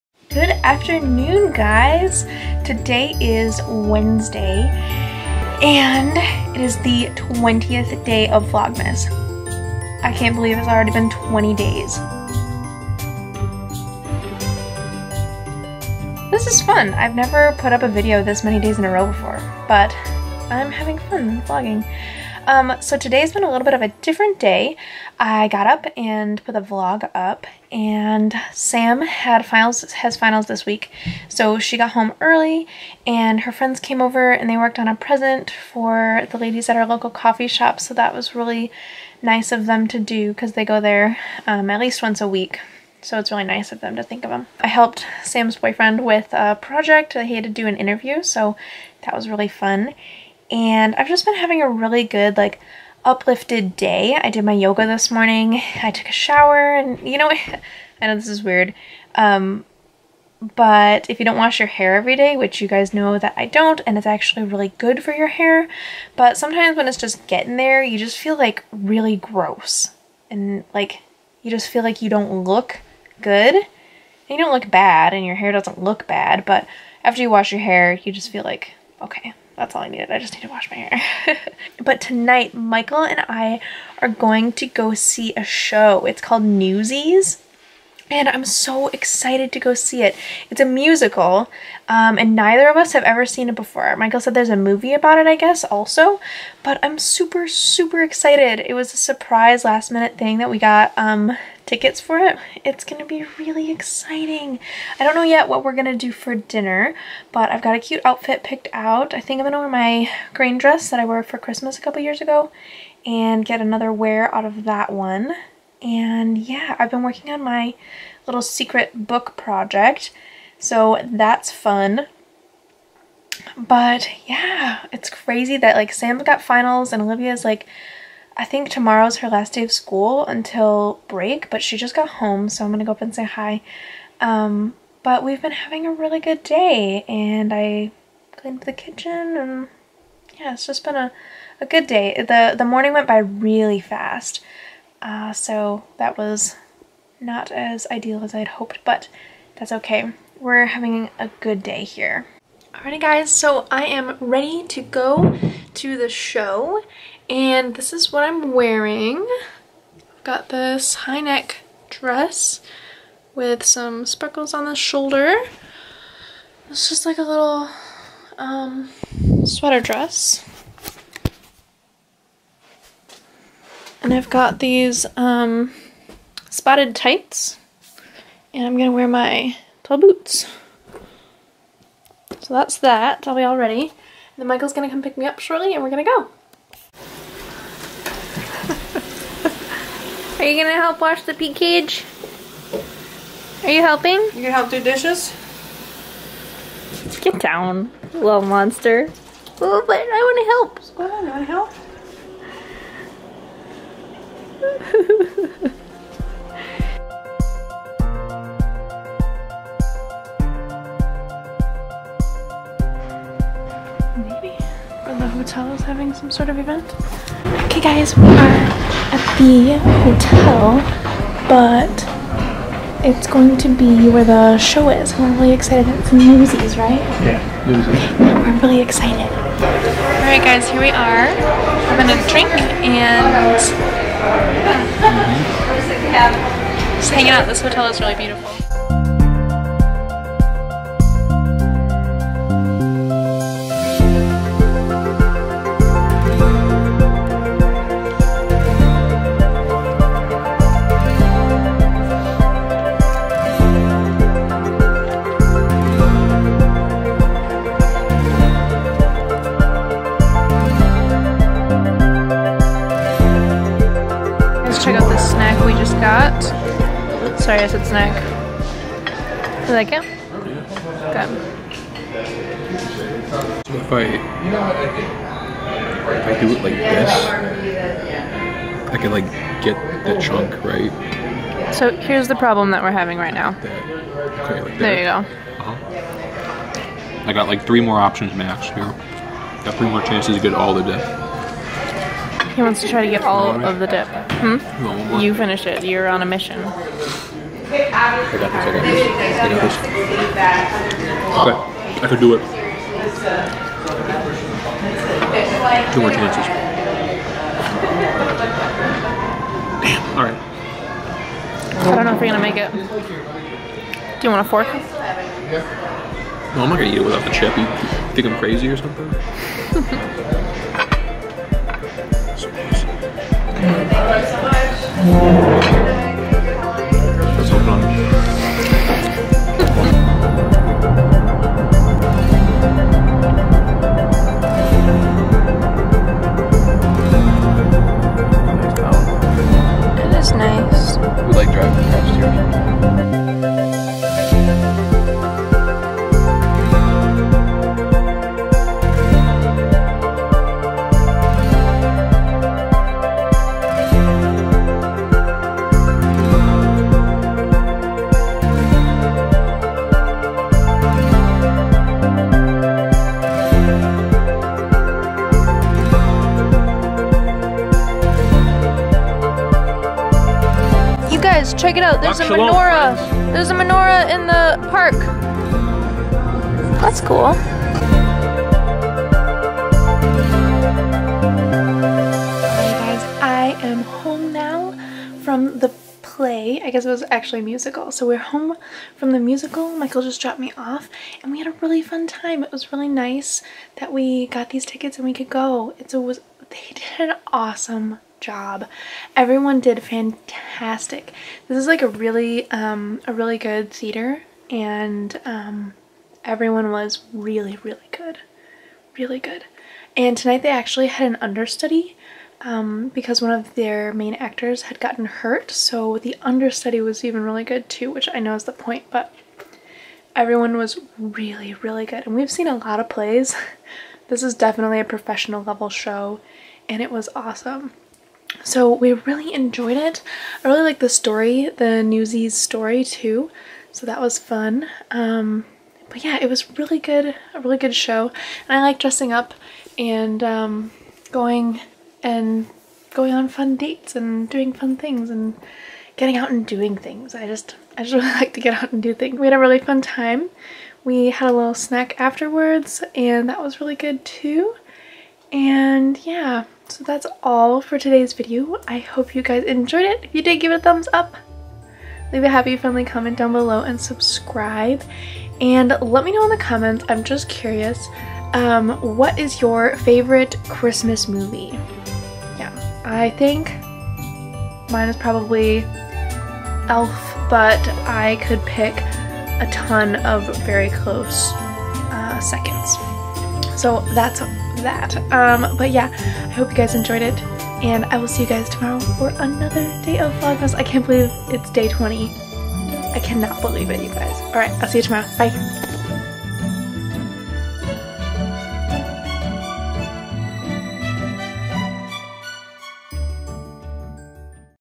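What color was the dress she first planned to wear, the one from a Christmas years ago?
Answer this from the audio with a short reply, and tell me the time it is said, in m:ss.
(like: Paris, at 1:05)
Green, at 1:50.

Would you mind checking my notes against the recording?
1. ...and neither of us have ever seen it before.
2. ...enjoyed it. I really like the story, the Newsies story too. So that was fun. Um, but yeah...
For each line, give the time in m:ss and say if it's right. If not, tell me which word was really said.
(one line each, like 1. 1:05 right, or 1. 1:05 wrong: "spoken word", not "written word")
1. 1:32 right
2. 7:09 right.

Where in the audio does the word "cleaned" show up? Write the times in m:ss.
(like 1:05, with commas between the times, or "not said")
2:18.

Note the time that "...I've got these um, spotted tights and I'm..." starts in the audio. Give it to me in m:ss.
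2:54.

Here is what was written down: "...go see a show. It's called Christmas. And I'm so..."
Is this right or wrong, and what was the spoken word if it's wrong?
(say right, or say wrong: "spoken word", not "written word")
wrong: "Newsies", not "Christmas".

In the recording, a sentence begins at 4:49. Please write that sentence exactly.
Got three more chances to get all the death.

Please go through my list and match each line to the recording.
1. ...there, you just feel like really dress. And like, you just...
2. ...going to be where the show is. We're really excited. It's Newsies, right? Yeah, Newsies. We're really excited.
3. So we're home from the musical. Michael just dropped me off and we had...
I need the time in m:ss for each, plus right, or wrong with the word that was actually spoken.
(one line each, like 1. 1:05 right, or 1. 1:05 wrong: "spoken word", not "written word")
1. 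1:07 wrong: "gross", not "dress"
2. 3:43 right
3. 6:27 right.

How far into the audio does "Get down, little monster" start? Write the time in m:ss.
3:17.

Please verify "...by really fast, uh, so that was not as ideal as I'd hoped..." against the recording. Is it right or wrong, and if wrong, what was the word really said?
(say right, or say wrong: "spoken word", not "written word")
right.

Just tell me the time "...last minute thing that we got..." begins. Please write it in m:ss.
1:39.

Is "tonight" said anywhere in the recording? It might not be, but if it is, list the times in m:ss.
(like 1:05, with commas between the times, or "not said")
1:22, 6:50.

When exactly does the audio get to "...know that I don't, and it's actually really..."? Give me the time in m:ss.
1:02.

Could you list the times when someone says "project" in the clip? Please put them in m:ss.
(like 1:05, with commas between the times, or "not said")
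0:46, 1:59.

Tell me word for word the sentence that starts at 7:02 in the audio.
And we've seen a lot of plays.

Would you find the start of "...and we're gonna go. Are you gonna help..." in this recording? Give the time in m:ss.
3:05.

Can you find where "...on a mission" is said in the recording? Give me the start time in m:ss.
4:56.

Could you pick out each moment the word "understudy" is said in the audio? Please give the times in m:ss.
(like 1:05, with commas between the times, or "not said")
6:51, 6:56.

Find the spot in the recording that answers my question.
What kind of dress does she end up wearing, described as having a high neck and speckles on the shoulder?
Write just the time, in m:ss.
2:49.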